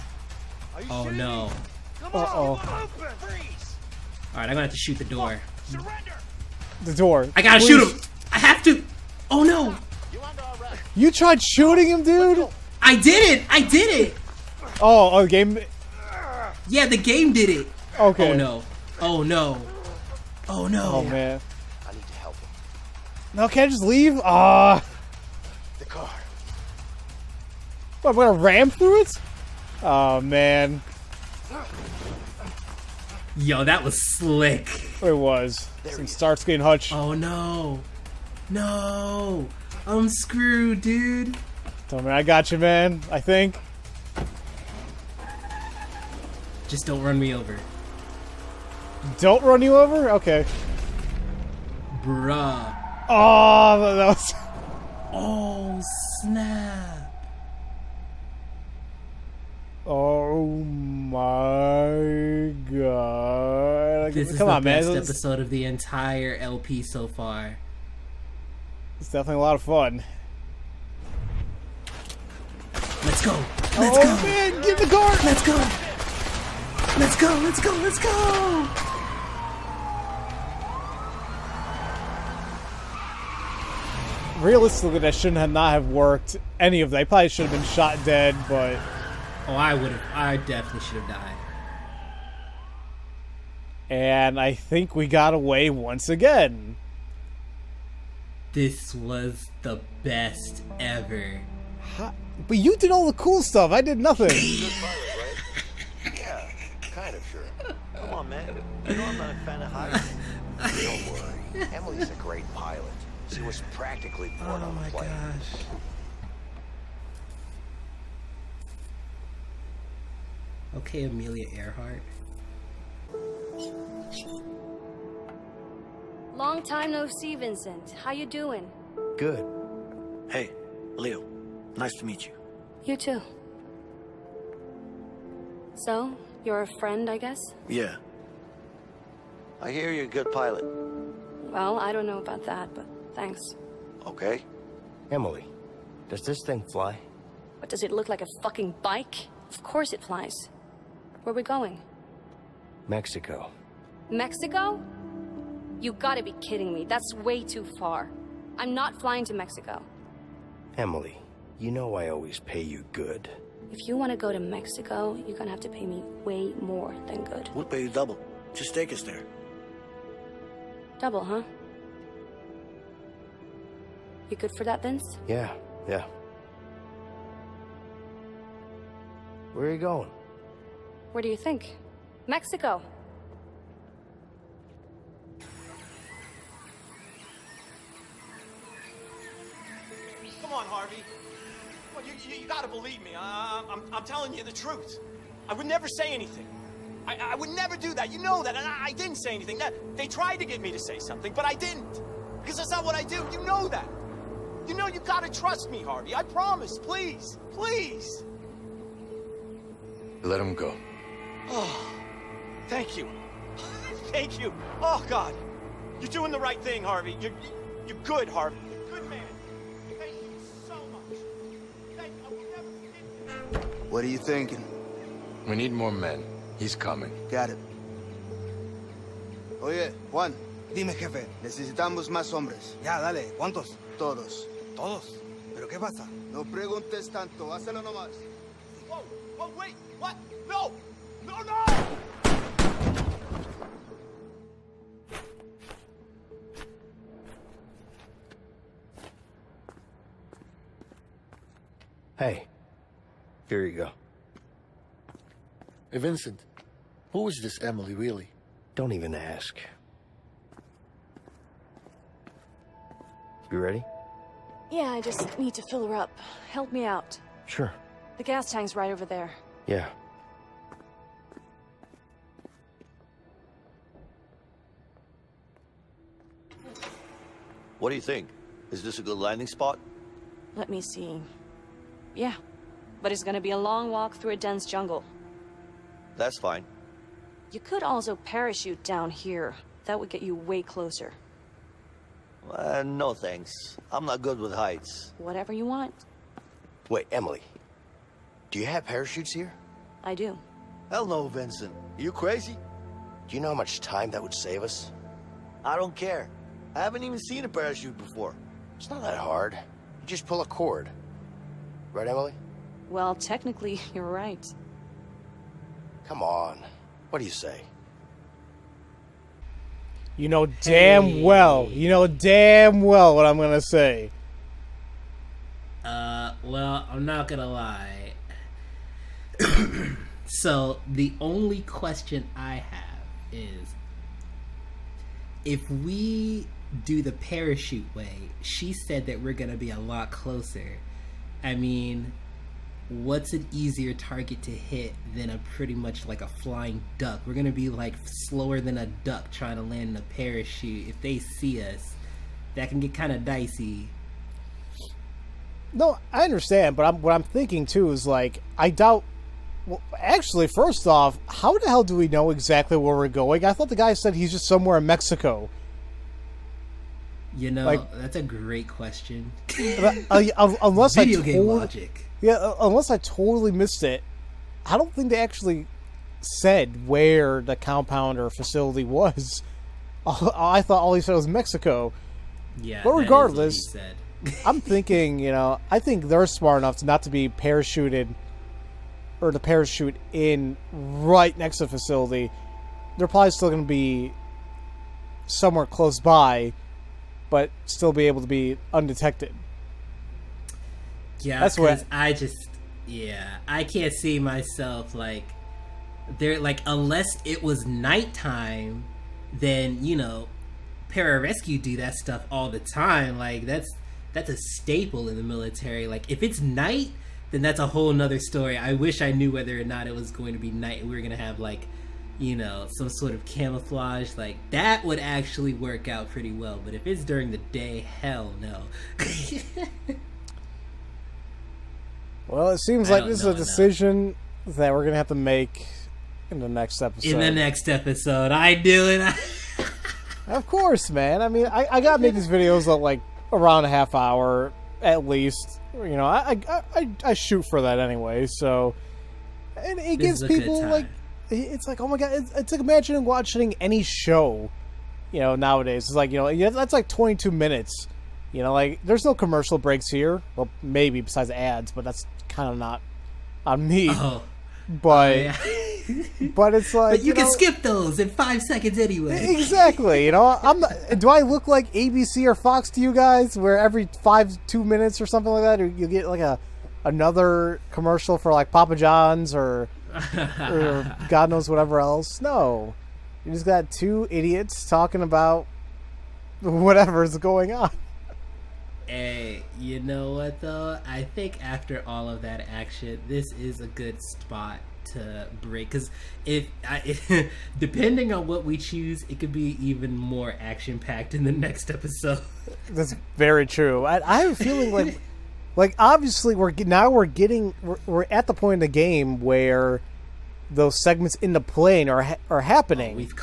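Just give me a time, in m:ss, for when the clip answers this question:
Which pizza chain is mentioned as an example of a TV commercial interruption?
7:58.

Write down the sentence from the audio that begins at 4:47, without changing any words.
You could also parachute down here.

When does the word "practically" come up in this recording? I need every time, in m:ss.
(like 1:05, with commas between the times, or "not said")
1:53.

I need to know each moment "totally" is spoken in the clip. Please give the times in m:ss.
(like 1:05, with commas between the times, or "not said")
6:12.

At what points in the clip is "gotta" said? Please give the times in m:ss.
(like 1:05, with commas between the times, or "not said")
0:07, 2:35, 3:12, 3:25, 7:21.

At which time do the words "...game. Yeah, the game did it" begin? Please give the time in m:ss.
0:15.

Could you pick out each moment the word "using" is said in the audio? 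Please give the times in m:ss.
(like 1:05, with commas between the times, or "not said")
not said.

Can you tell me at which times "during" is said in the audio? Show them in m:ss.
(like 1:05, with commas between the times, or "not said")
7:07.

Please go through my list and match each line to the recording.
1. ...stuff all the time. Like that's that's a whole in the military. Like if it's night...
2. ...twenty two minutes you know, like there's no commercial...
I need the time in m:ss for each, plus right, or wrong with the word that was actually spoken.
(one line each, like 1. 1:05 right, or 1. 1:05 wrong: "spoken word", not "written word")
1. 6:51 wrong: "staple", not "whole"
2. 7:36 right.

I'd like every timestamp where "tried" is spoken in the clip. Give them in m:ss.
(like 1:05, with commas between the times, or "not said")
0:11, 3:20.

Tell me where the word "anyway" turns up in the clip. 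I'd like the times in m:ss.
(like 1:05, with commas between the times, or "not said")
7:27, 7:48.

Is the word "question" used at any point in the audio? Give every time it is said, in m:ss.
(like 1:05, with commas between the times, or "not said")
5:31, 6:08.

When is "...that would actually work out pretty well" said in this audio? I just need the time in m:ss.
7:04.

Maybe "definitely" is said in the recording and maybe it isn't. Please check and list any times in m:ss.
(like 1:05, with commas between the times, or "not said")
1:09, 1:30.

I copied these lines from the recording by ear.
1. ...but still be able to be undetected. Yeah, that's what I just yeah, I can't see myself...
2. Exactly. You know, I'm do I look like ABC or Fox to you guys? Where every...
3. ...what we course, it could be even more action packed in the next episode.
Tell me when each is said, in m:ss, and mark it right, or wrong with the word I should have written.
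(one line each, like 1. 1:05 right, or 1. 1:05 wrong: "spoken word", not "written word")
1. 6:37 right
2. 7:49 right
3. 8:18 wrong: "choose", not "course".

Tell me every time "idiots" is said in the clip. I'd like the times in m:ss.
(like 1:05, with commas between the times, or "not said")
8:04.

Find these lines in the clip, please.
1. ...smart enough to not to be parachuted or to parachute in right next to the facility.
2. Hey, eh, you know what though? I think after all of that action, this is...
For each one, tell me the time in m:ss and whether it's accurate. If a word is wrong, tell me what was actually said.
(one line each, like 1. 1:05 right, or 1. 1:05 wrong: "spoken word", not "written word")
1. 6:26 right
2. 8:08 right.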